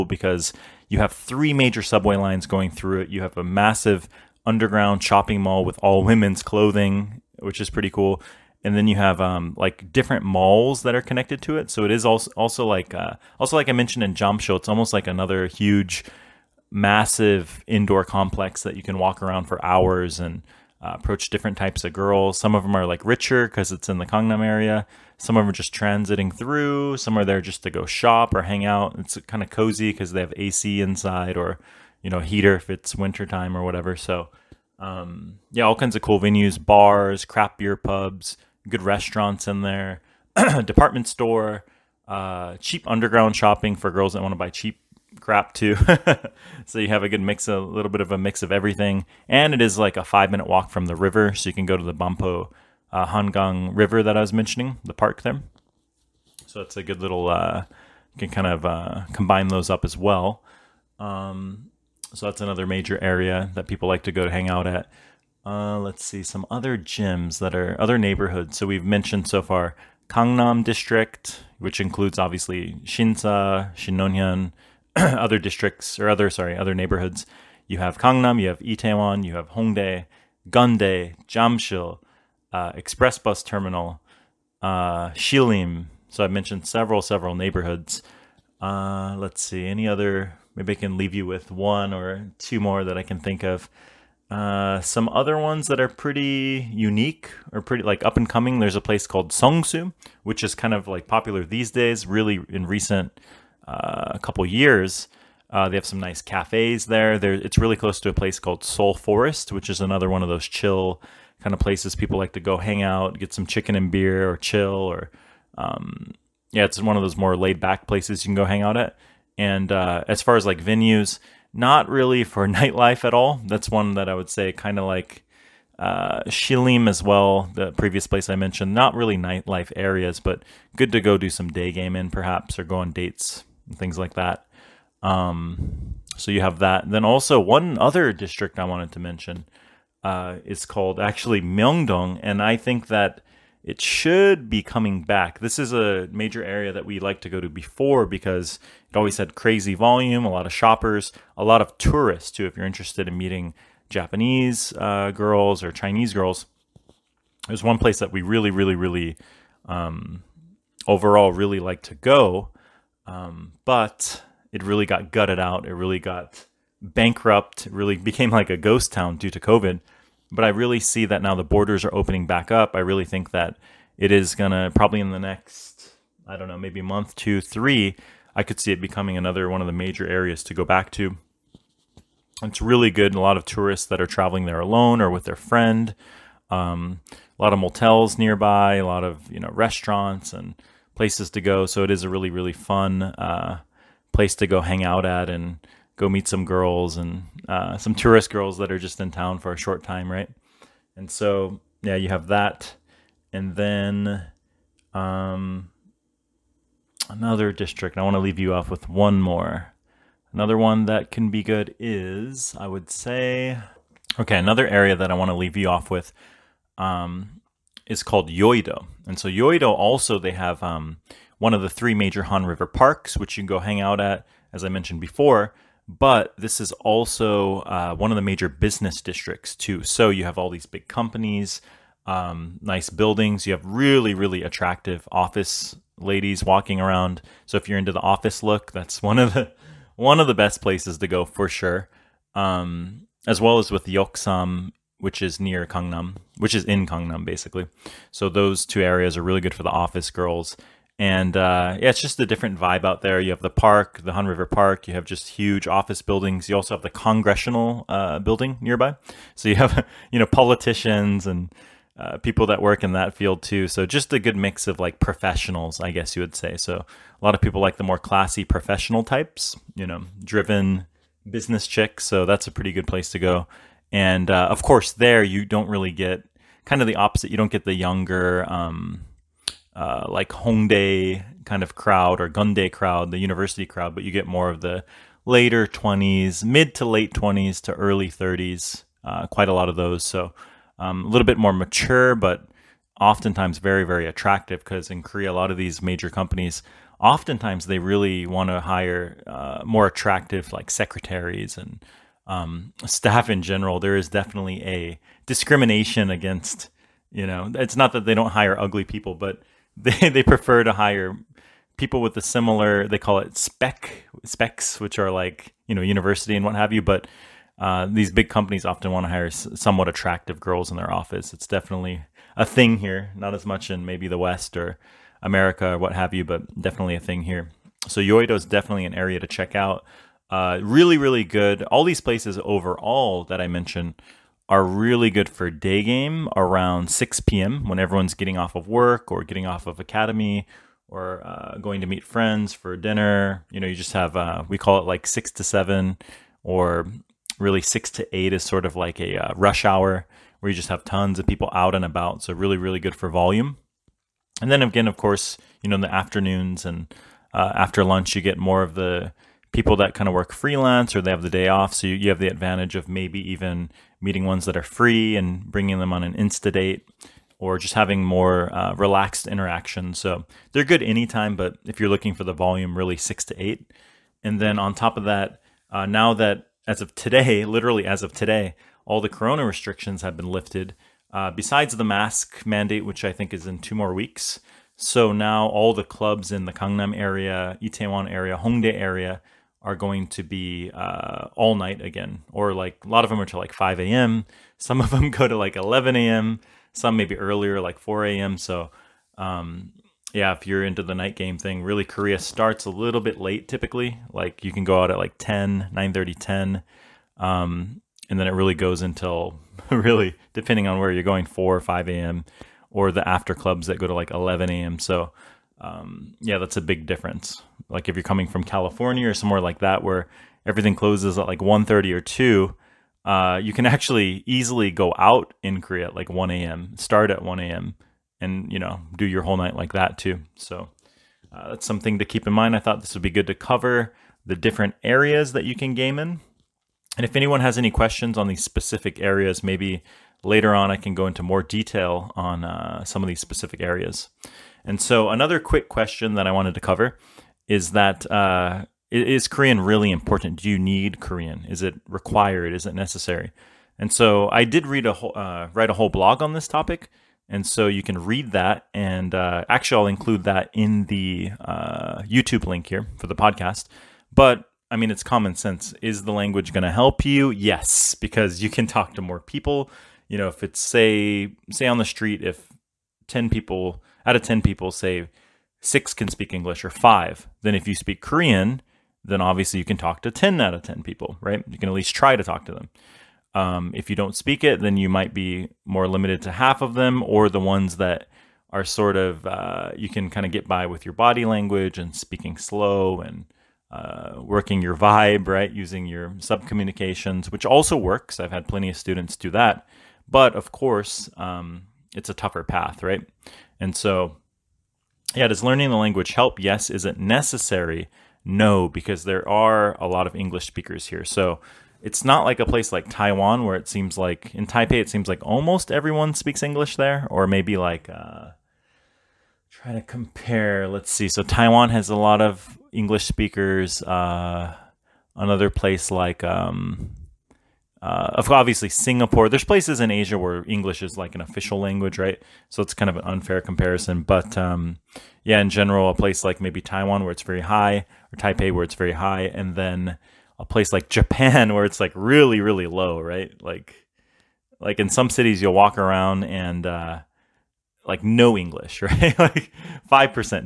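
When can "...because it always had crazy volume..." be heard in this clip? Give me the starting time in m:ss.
2:28.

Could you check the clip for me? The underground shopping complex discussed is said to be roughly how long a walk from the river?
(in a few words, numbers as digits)
5 minutes.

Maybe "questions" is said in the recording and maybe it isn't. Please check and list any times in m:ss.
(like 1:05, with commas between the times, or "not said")
7:17, 7:25.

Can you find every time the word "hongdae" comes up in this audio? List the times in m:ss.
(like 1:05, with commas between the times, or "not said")
1:19, 4:40, 6:28.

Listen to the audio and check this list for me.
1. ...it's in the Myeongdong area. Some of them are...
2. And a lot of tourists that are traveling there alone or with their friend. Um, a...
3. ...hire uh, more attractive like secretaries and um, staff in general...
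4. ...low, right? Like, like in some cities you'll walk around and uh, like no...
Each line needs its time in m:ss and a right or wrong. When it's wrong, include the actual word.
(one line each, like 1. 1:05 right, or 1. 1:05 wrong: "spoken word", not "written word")
1. 0:23 wrong: "Gangnam", not "Myeongdong"
2. 3:03 right
3. 4:58 right
4. 9:02 right.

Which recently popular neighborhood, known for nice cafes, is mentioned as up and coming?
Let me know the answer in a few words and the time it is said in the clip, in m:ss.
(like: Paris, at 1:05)
Songsu, at 1:39.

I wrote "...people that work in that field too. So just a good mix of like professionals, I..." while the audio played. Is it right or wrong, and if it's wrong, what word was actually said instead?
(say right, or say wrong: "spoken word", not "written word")
right.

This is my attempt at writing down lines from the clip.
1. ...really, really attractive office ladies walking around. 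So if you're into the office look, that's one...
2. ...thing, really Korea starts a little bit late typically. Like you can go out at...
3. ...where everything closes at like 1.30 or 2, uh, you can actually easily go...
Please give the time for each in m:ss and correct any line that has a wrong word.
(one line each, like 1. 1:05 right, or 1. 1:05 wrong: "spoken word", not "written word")
1. 3:53 right
2. 6:41 right
3. 6:59 right.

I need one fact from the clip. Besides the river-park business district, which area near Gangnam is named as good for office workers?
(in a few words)
Yoksam.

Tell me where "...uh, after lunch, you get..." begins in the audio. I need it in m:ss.
5:57.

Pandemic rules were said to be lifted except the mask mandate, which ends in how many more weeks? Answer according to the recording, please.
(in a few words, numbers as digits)
2 weeks.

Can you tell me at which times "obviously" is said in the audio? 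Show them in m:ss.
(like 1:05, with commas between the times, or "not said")
1:12, 7:59, 8:48.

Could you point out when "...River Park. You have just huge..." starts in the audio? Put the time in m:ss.
4:14.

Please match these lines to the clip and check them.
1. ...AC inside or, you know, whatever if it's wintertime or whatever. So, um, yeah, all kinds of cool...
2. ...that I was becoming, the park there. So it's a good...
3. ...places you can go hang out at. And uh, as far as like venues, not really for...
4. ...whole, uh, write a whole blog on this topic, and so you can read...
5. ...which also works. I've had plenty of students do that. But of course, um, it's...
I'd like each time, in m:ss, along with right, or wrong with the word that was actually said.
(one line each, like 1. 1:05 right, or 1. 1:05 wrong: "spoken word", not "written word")
1. 0:30 wrong: "heater", not "whatever"
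2. 0:54 wrong: "mentioning", not "becoming"
3. 1:57 right
4. 7:34 right
5. 8:17 right.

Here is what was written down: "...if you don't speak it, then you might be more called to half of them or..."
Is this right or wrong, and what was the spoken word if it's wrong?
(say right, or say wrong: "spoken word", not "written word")
wrong: "limited", not "called".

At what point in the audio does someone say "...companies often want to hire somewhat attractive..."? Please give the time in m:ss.
5:18.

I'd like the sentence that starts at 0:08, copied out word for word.
And then you have um, like different malls that are connected to it.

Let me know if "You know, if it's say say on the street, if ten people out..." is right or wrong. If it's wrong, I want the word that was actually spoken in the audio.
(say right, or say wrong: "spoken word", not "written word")
right.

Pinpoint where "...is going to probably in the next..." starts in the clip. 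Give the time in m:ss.
2:54.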